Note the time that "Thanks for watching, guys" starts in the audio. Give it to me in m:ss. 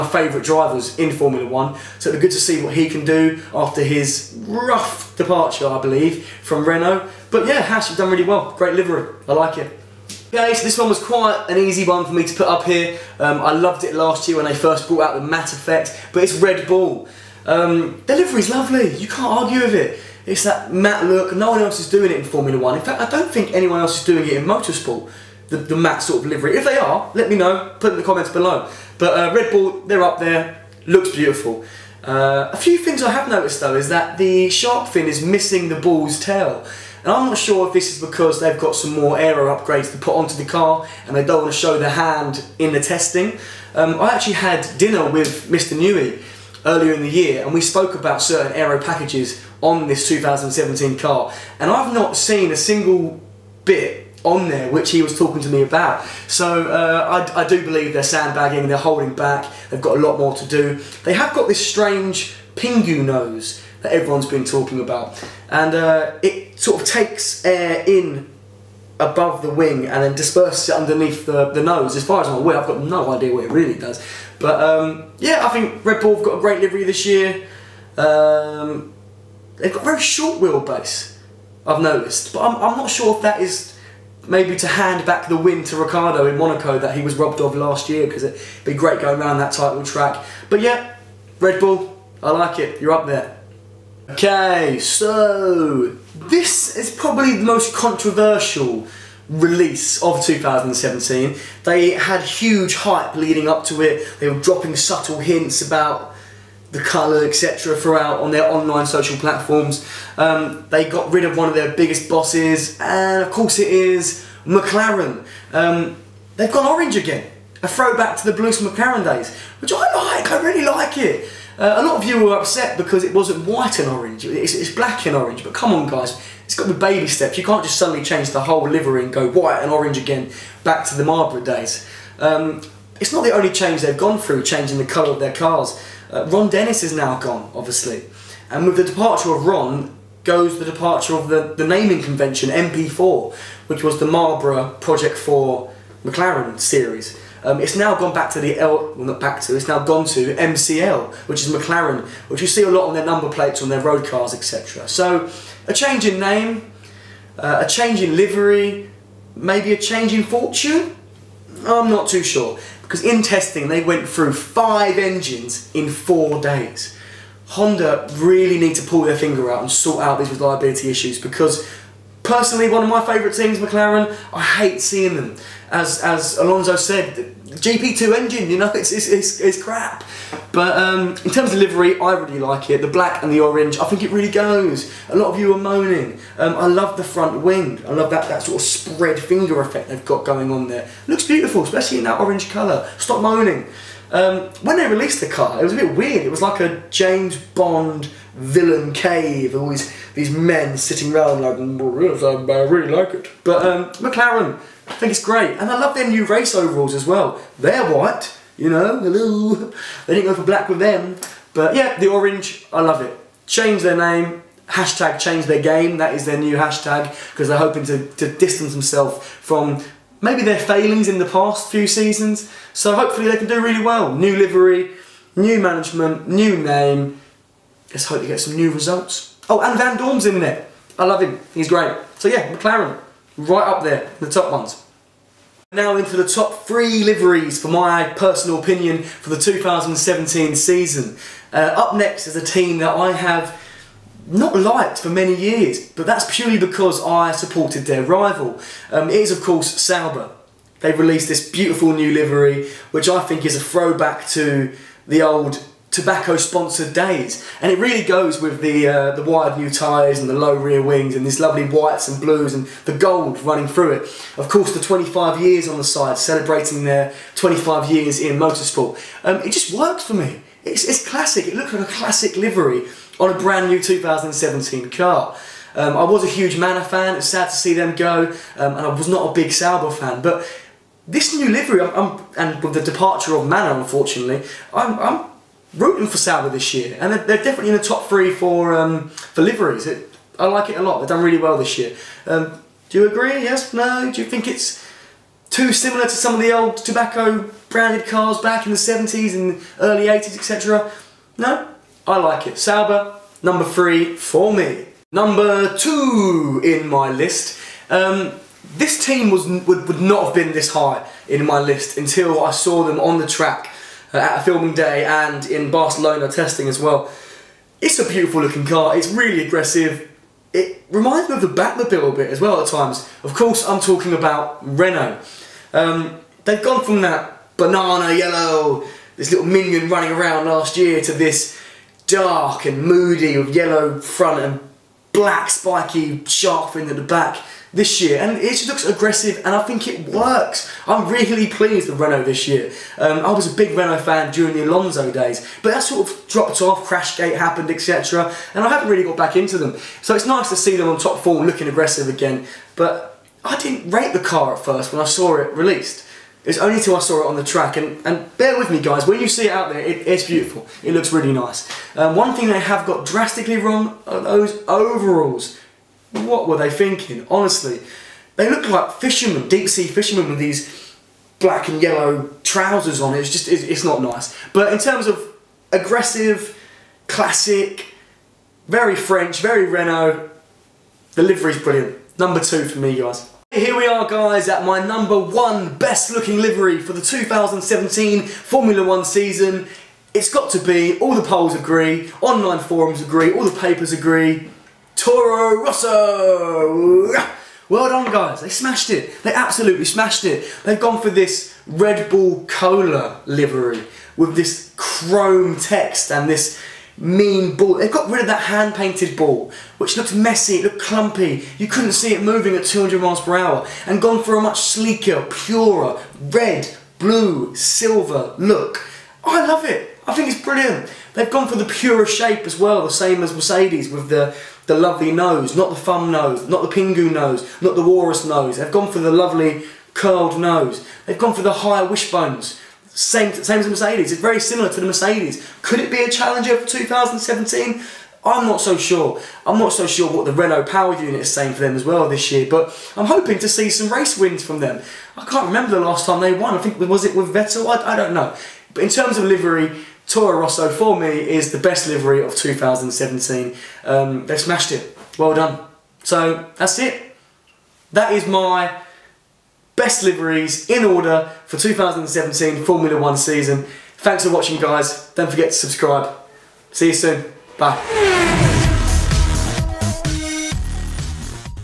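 7:43.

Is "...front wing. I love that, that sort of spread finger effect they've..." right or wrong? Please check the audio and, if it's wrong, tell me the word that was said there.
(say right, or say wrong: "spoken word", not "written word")
right.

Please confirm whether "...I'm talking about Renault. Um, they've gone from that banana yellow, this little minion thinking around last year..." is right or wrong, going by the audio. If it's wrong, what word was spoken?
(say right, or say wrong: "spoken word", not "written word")
wrong: "running", not "thinking".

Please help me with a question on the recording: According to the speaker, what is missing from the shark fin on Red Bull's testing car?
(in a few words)
The bull's tail.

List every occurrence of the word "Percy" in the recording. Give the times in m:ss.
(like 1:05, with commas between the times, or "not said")
not said.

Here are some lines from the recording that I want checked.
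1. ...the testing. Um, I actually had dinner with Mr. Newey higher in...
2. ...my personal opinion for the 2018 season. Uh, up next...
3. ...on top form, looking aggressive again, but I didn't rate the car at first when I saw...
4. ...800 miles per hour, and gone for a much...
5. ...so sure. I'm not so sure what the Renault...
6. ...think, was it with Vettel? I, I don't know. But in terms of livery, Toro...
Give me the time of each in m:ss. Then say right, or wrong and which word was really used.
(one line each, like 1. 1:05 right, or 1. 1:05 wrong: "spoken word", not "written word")
1. 0:42 wrong: "earlier", not "higher"
2. 3:57 wrong: "2017", not "2018"
3. 5:50 right
4. 6:52 wrong: "200", not "800"
5. 7:18 right
6. 7:26 right.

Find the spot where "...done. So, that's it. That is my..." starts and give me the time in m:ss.
7:35.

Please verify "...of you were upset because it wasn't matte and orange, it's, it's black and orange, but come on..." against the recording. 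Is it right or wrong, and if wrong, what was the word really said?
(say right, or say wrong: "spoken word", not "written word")
wrong: "white", not "matte".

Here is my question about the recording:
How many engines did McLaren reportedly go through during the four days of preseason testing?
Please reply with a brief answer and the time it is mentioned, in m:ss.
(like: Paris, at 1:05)
5, at 2:44.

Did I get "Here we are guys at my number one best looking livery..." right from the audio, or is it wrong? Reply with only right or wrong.
right.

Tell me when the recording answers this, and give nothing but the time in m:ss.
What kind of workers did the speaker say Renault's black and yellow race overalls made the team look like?
6:09.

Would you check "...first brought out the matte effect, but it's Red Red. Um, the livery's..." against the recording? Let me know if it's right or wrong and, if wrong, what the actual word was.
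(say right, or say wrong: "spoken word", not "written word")
wrong: "Bull", not "Red".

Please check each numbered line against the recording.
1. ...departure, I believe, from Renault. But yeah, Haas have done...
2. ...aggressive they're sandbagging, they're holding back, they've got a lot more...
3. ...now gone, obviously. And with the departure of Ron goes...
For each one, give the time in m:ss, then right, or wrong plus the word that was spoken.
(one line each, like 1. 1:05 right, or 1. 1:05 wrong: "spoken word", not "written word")
1. 0:05 right
2. 0:57 wrong: "believe", not "aggressive"
3. 2:16 right.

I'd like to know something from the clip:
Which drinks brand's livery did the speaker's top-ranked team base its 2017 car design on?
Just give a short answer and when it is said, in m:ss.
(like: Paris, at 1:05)
Red Bull Cola, at 6:41.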